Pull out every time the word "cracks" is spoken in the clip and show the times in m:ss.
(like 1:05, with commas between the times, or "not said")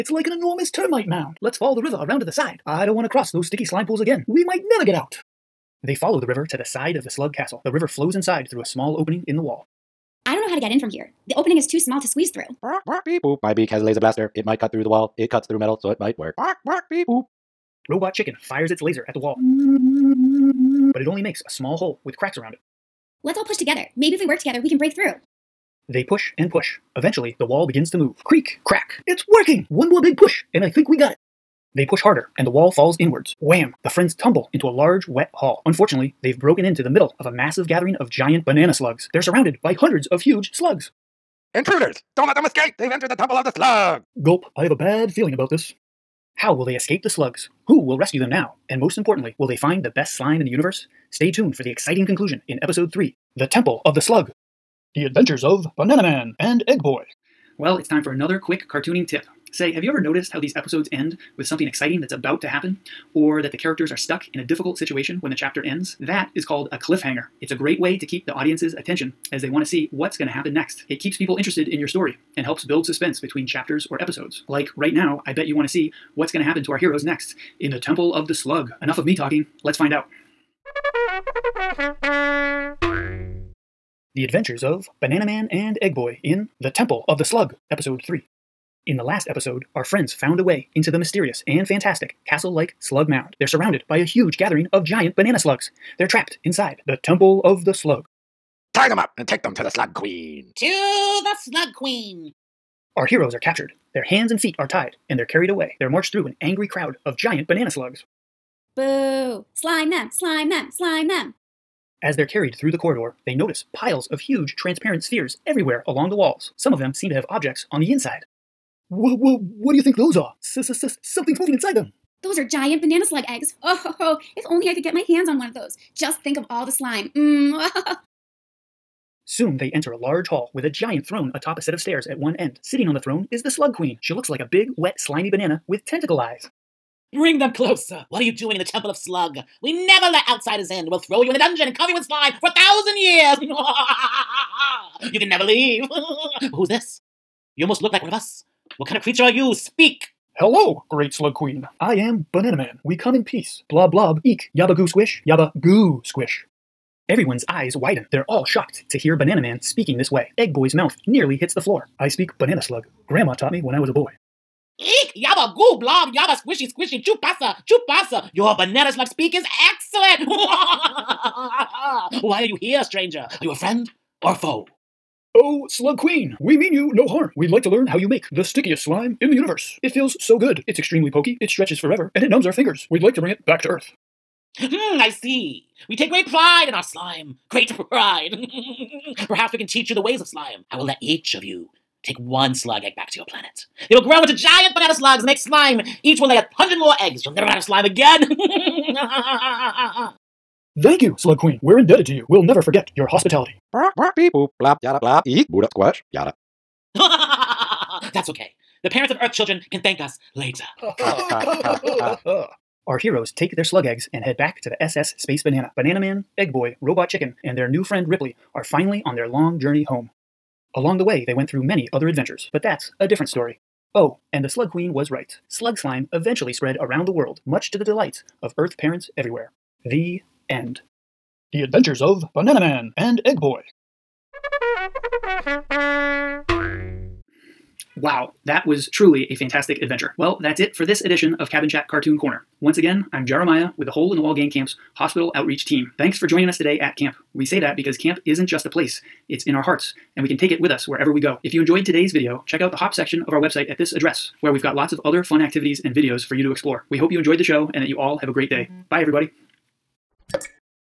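0:22, 0:28.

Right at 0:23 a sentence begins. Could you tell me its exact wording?
Maybe if we work together, we can break through.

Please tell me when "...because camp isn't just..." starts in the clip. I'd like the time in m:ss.
4:07.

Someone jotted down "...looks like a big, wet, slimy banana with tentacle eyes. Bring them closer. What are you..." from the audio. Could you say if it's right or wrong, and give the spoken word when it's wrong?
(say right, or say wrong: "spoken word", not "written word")
right.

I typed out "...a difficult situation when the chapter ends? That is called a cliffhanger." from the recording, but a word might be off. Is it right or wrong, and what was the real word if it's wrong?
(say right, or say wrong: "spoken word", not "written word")
right.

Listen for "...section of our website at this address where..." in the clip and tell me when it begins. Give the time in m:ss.
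4:12.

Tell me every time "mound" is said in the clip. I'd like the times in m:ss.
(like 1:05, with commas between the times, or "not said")
0:01, 1:33.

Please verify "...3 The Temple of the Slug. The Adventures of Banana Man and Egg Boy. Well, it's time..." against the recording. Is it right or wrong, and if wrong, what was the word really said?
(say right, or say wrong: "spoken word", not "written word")
right.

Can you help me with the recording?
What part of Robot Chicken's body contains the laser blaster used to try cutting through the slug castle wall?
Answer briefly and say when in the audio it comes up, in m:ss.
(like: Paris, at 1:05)
Beak, at 0:13.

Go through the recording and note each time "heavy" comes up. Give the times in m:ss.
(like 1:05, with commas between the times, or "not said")
not said.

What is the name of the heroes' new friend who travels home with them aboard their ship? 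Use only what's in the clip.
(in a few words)
Ripley.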